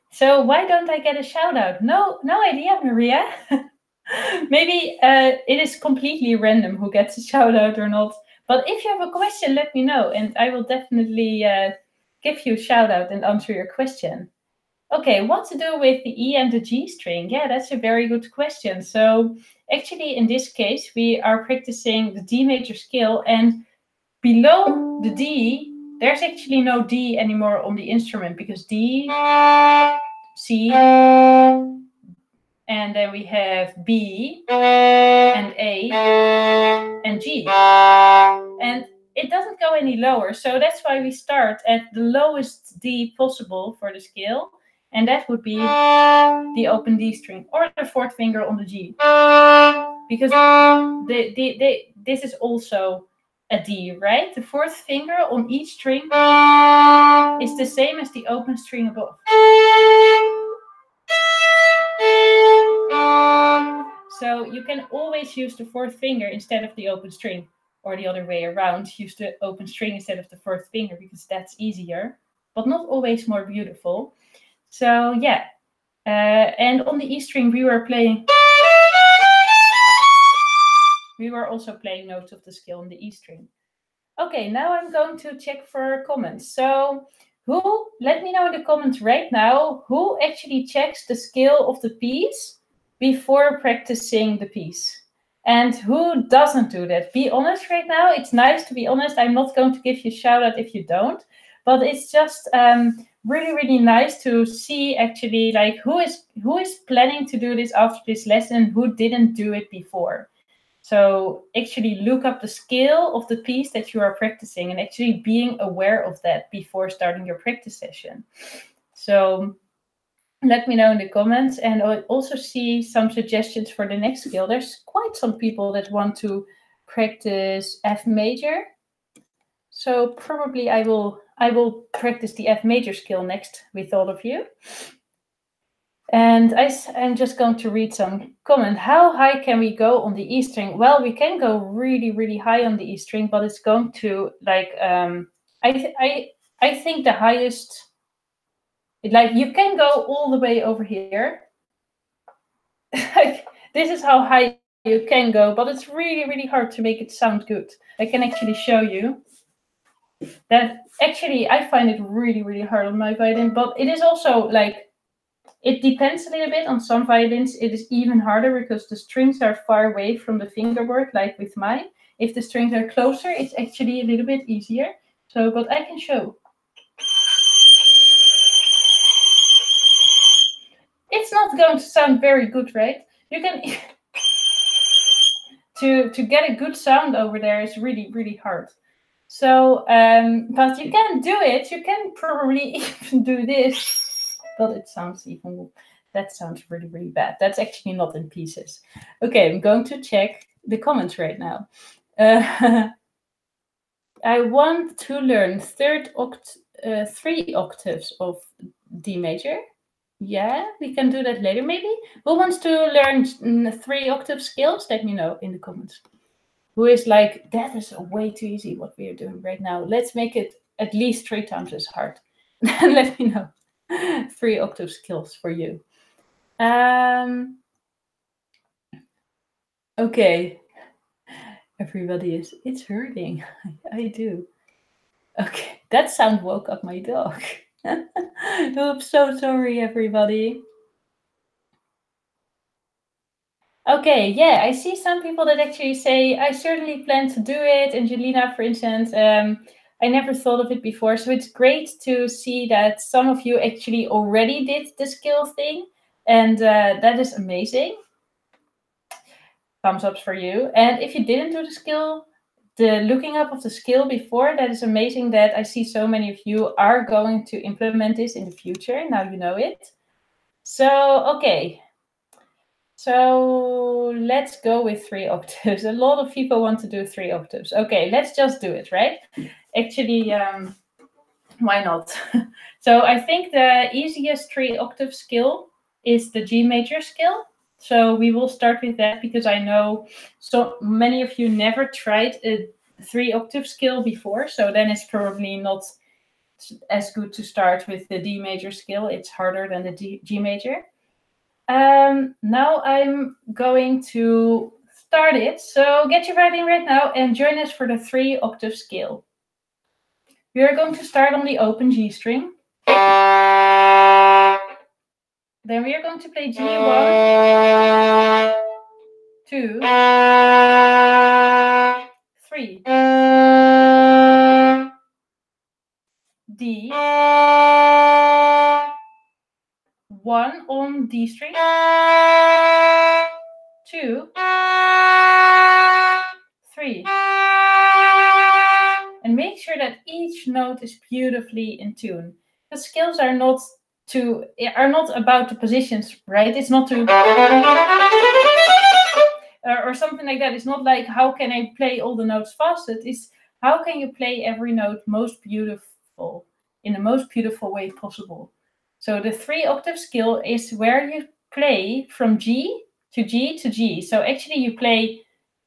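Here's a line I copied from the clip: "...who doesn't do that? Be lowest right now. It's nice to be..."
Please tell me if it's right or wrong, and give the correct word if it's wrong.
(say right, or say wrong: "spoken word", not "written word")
wrong: "honest", not "lowest".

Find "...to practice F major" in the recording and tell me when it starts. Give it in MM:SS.
02:06.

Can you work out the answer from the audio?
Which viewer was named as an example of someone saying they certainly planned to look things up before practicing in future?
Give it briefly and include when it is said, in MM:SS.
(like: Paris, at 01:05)
Angelina, at 04:07.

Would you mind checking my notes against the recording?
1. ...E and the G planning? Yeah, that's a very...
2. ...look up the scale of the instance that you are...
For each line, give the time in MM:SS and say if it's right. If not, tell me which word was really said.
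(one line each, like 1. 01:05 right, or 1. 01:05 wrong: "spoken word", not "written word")
1. 00:16 wrong: "string", not "planning"
2. 01:52 wrong: "piece", not "instance".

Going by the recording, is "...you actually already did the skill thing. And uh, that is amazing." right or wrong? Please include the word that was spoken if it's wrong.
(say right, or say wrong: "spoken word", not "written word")
right.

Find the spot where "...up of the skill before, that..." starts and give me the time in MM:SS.
04:23.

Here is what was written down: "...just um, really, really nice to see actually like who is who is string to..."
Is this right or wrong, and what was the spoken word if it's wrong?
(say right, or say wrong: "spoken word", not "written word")
wrong: "planning", not "string".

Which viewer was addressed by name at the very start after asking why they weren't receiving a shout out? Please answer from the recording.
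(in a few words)
Maria.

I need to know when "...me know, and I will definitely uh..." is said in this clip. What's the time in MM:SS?
00:09.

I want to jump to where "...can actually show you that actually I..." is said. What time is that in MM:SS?
02:38.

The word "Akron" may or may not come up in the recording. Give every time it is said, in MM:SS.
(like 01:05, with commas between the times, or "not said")
not said.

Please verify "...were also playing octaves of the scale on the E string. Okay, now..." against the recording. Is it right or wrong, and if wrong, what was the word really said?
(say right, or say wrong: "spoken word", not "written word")
wrong: "notes", not "octaves".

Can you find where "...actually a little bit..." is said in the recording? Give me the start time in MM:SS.
02:53.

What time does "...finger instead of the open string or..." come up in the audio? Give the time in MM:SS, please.
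01:05.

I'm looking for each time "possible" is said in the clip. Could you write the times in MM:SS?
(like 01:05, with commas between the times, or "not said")
00:43, 05:57.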